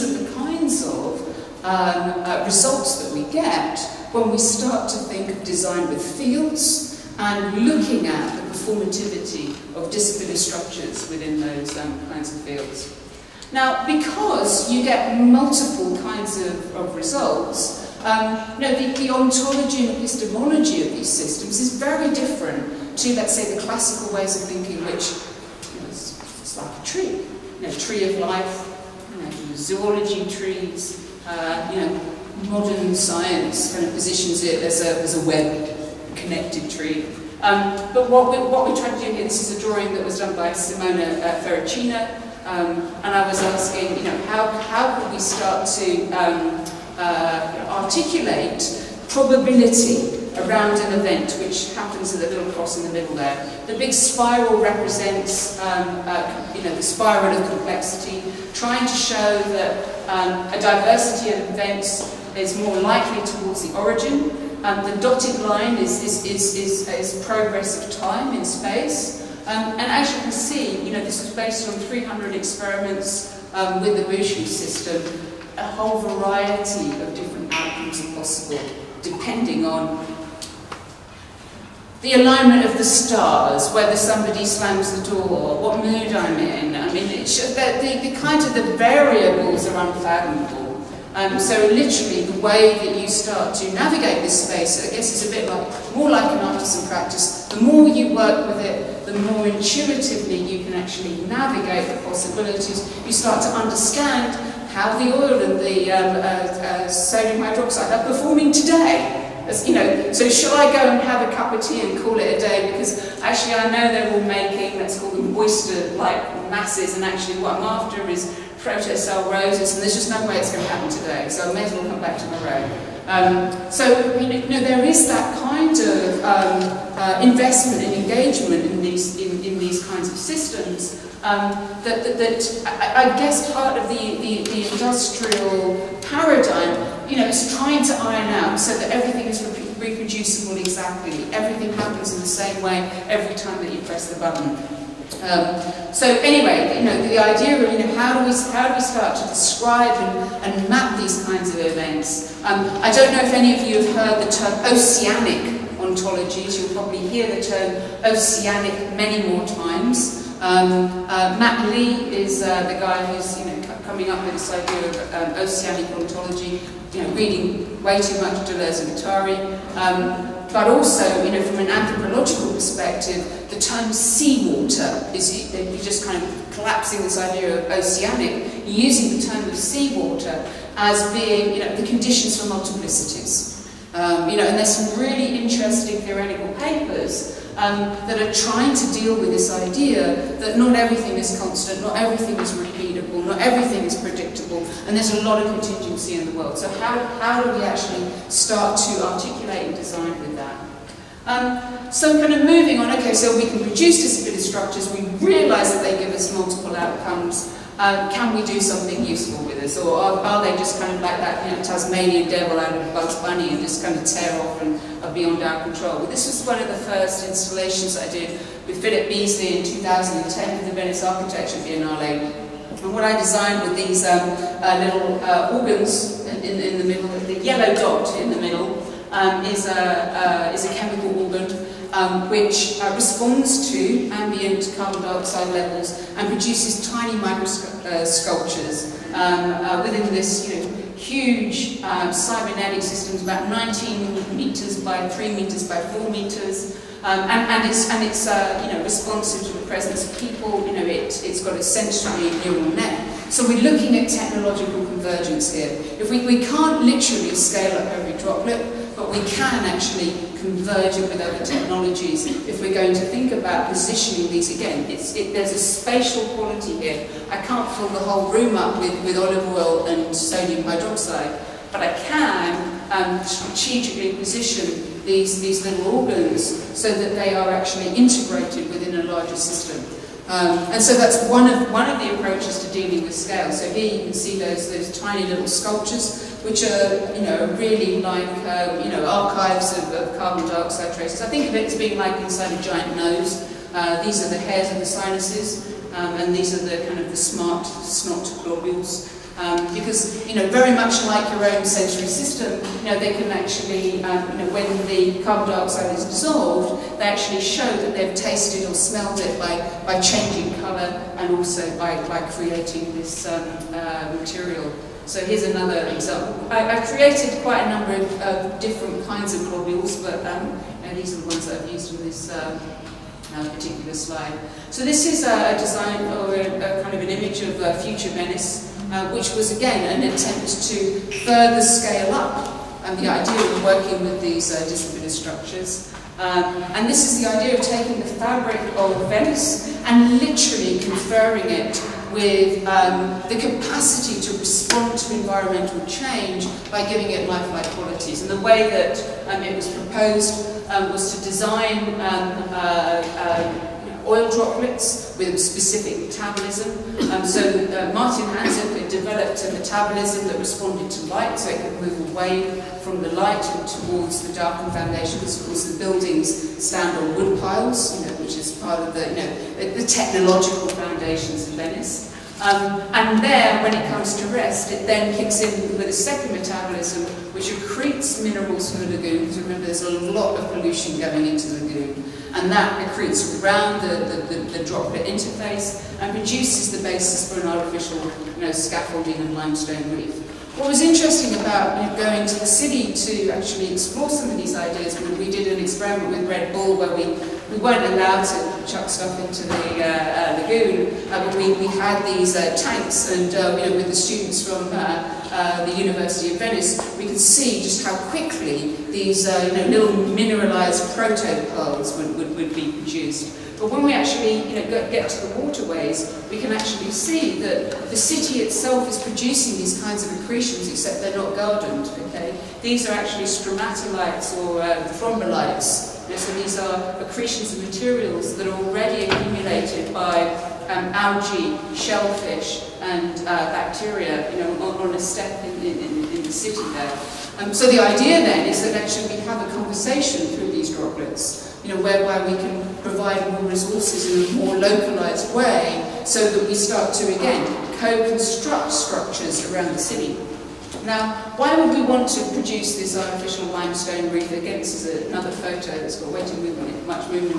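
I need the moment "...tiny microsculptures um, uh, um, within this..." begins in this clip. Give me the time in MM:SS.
03:56.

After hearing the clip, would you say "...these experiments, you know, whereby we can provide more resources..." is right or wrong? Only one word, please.
wrong.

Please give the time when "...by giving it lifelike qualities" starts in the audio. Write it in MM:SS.
05:46.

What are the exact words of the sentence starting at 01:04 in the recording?
Um, the dotted line is, is, is, is, is progress of time in space.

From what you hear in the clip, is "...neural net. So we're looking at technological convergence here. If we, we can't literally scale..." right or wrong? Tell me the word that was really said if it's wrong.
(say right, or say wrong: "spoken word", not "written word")
right.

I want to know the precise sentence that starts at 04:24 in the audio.
It, there's a spatial quality here.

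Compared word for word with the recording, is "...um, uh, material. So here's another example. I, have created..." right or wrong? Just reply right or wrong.
right.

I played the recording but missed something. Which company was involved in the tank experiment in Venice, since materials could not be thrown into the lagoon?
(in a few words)
Red Bull.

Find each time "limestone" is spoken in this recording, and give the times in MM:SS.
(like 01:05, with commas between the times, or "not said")
06:29, 07:33.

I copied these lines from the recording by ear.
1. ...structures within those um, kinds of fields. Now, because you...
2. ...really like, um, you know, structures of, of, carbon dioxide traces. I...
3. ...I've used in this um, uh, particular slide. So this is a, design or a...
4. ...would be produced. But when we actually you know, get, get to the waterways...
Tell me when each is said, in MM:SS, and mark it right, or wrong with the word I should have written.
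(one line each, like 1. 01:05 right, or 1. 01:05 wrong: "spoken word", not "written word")
1. 00:10 right
2. 04:47 wrong: "archives", not "structures"
3. 05:21 right
4. 06:52 right.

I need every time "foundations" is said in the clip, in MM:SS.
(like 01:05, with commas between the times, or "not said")
06:04, 06:10.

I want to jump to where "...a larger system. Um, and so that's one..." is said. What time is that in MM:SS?
04:39.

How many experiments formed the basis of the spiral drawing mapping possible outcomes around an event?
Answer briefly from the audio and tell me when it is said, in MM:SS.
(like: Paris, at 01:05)
300, at 01:11.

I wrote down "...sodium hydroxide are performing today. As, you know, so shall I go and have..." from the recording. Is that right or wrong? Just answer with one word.
right.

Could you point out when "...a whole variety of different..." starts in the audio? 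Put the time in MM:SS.
01:15.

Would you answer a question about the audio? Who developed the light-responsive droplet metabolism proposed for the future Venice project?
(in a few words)
Martin Hansen.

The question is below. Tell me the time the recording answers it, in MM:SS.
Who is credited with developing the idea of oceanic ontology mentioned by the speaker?
02:41.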